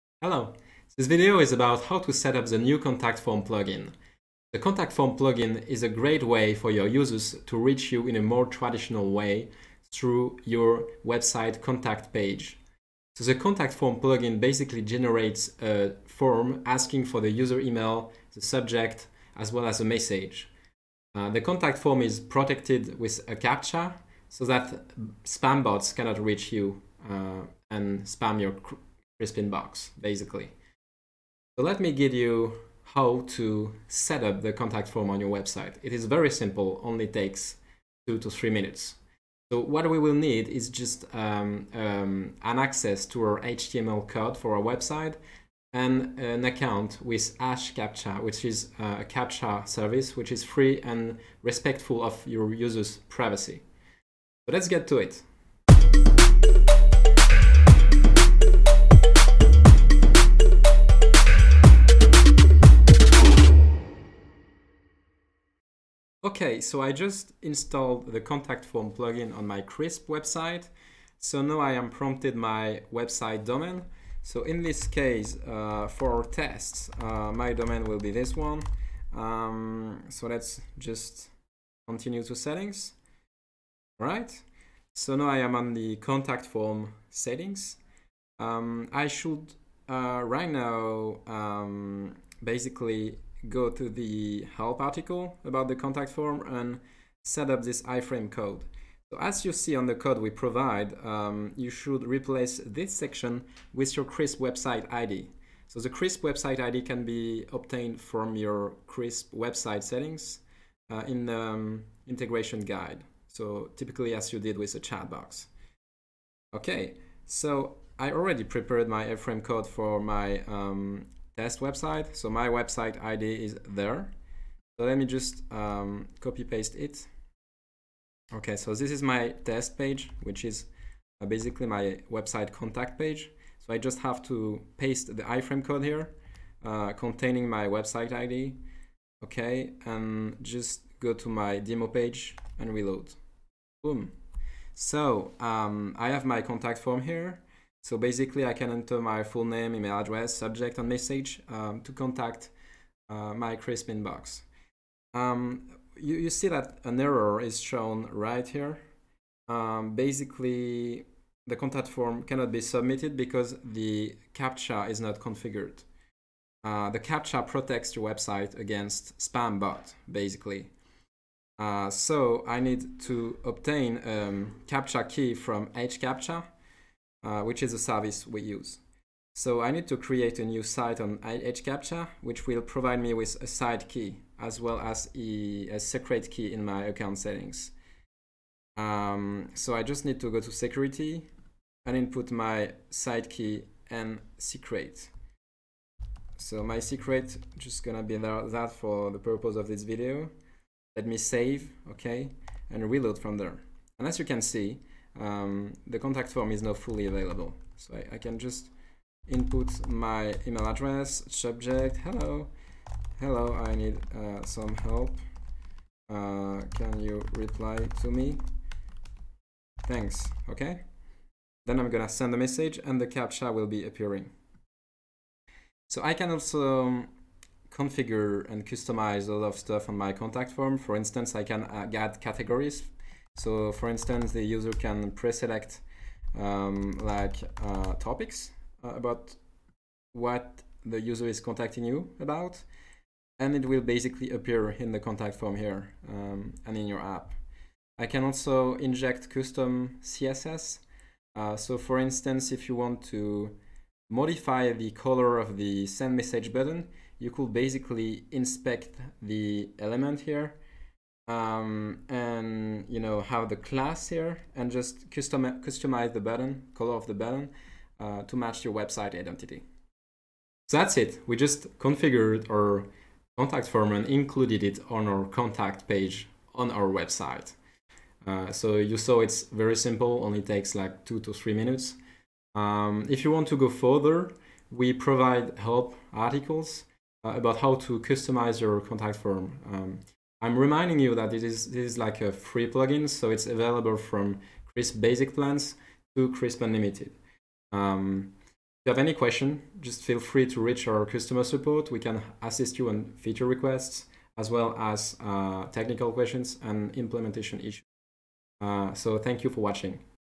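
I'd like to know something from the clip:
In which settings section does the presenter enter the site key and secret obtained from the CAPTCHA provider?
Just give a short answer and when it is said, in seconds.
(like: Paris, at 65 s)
security, at 190 s.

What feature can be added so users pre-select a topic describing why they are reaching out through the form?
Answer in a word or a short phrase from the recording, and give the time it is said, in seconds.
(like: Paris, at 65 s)
categories, at 232 s.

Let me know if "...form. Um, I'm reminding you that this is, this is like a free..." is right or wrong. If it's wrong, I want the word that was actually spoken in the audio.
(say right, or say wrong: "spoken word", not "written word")
right.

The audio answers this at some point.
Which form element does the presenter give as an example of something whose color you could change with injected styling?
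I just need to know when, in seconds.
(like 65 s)
255 s.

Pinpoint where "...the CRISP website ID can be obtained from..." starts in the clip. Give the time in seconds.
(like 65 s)
105 s.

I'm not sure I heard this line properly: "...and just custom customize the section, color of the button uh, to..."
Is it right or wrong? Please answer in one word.
wrong.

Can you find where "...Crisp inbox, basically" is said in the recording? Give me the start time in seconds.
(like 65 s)
29 s.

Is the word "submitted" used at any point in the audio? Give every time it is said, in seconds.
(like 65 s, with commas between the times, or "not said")
162 s.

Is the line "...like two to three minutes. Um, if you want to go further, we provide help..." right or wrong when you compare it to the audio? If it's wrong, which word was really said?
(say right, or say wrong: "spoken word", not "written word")
right.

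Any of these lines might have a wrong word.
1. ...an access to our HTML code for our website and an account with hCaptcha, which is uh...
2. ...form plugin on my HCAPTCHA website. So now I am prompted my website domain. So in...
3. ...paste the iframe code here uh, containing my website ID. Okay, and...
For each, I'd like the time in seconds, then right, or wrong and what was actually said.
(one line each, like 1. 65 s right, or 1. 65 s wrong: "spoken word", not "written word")
1. 42 s right
2. 68 s wrong: "Crisp", not "HCAPTCHA"
3. 134 s right.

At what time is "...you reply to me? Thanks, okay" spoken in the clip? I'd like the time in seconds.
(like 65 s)
216 s.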